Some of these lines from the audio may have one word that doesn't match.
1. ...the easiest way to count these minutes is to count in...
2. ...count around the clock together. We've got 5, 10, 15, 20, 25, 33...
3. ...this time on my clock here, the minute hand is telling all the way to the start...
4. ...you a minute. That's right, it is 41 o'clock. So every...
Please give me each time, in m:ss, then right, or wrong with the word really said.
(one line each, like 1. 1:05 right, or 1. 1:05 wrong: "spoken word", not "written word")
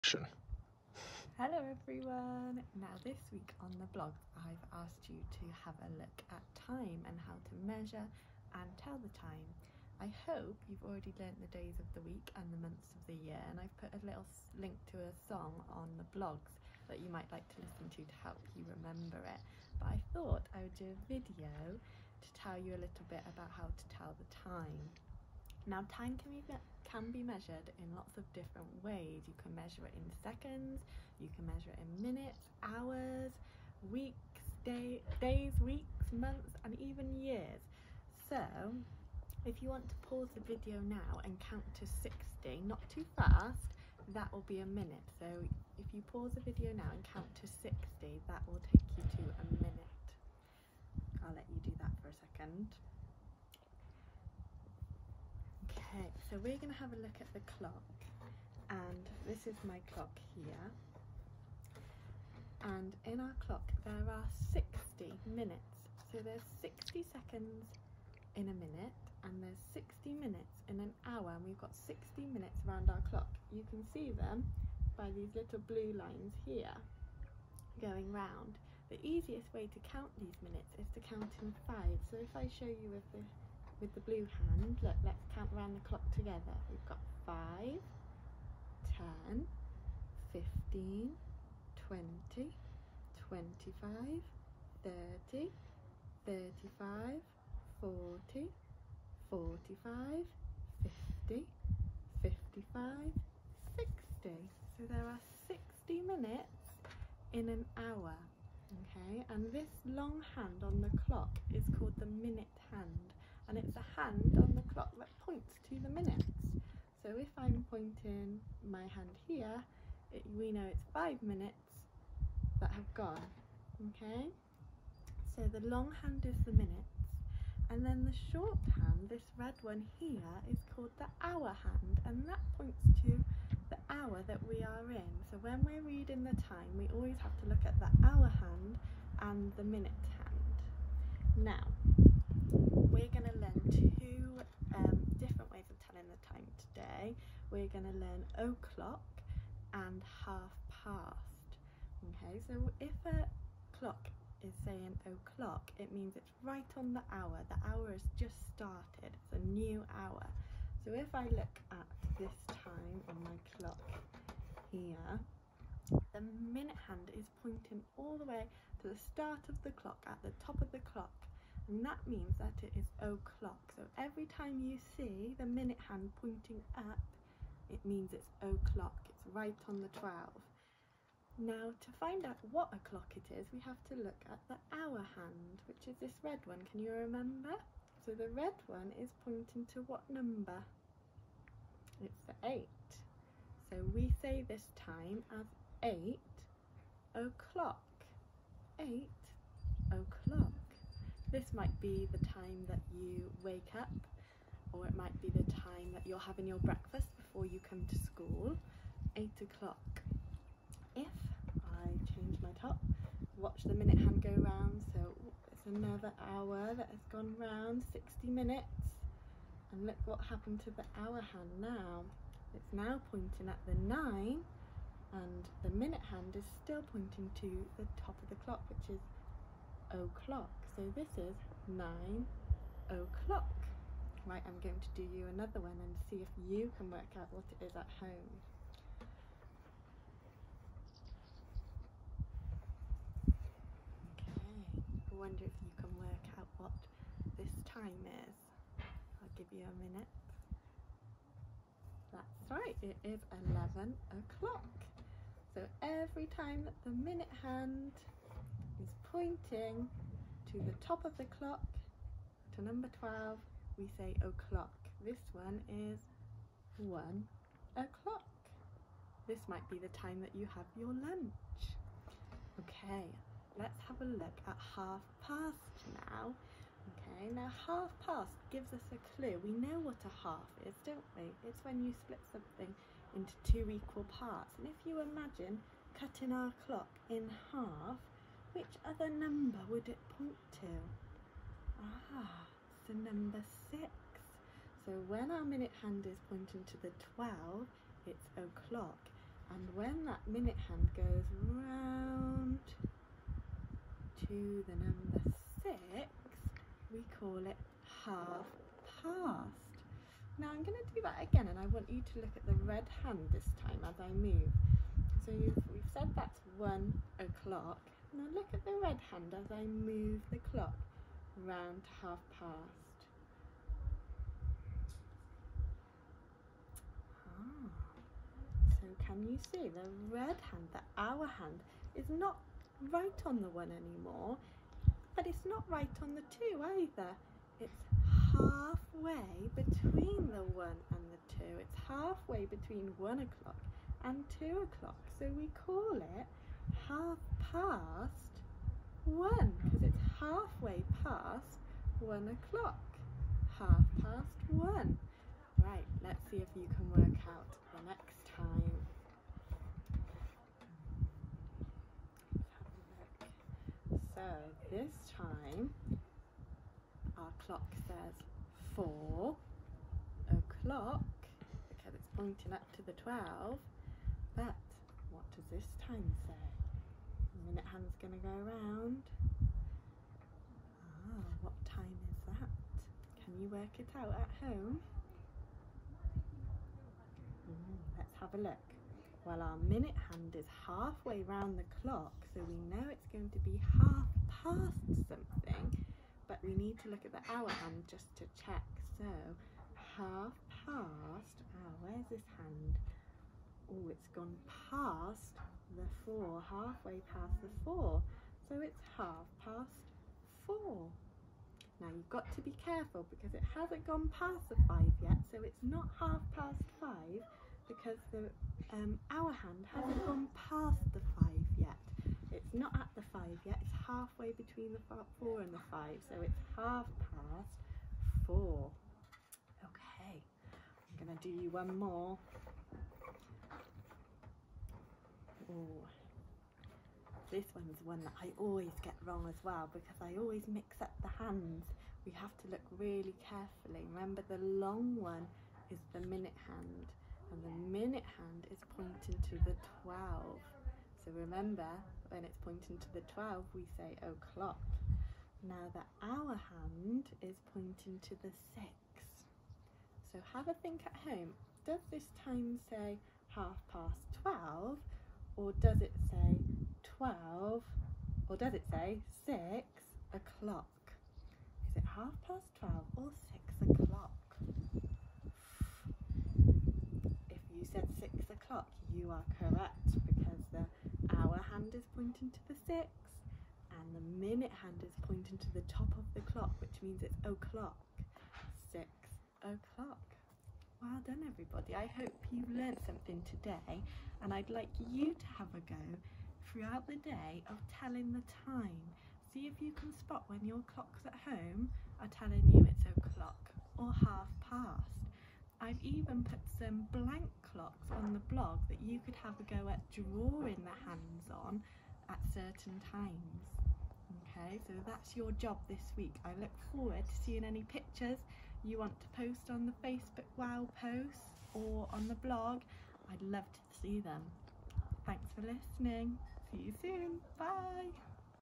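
1. 1:18 right
2. 1:25 wrong: "30", not "33"
3. 2:42 wrong: "pointing", not "telling"
4. 4:09 wrong: "11", not "41".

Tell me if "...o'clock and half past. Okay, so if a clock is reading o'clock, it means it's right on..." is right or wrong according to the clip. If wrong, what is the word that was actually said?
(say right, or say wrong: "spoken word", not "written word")
wrong: "saying", not "reading".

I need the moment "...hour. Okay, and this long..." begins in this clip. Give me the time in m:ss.
1:47.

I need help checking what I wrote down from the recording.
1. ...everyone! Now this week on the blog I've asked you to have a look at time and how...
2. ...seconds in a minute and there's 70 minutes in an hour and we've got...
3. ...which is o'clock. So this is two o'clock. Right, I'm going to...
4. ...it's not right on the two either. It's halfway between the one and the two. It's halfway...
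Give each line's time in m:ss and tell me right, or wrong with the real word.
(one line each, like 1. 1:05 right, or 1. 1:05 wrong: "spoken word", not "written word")
1. 0:01 right
2. 1:07 wrong: "60", not "70"
3. 3:48 wrong: "nine", not "two"
4. 5:35 right.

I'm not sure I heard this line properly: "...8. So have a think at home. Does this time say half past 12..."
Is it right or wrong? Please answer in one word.
wrong.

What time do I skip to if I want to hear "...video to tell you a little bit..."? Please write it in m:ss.
0:21.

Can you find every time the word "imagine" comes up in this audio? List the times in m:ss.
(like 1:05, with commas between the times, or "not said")
4:44.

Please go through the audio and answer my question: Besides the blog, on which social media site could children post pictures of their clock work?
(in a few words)
Facebook.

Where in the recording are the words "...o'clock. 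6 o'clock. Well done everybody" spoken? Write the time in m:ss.
8:07.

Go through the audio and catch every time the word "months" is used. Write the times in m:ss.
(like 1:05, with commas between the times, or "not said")
0:12, 0:36.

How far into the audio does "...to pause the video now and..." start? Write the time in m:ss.
0:39.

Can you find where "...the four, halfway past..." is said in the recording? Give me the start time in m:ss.
6:45.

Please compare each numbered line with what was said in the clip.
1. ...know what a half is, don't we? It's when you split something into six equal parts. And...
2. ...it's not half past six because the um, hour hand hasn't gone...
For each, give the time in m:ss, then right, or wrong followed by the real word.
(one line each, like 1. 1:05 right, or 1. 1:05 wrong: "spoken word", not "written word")
1. 4:39 wrong: "two", not "six"
2. 6:55 wrong: "five", not "six".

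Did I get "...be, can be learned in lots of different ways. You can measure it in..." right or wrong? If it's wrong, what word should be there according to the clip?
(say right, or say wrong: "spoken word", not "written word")
wrong: "measured", not "learned".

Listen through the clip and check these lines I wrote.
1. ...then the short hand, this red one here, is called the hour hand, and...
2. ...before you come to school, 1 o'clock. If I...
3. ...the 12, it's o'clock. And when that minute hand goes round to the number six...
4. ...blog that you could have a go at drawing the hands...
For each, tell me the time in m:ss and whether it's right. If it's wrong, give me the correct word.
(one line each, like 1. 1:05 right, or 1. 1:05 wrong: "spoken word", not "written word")
1. 2:07 right
2. 3:27 wrong: "8", not "1"
3. 4:56 right
4. 8:28 right.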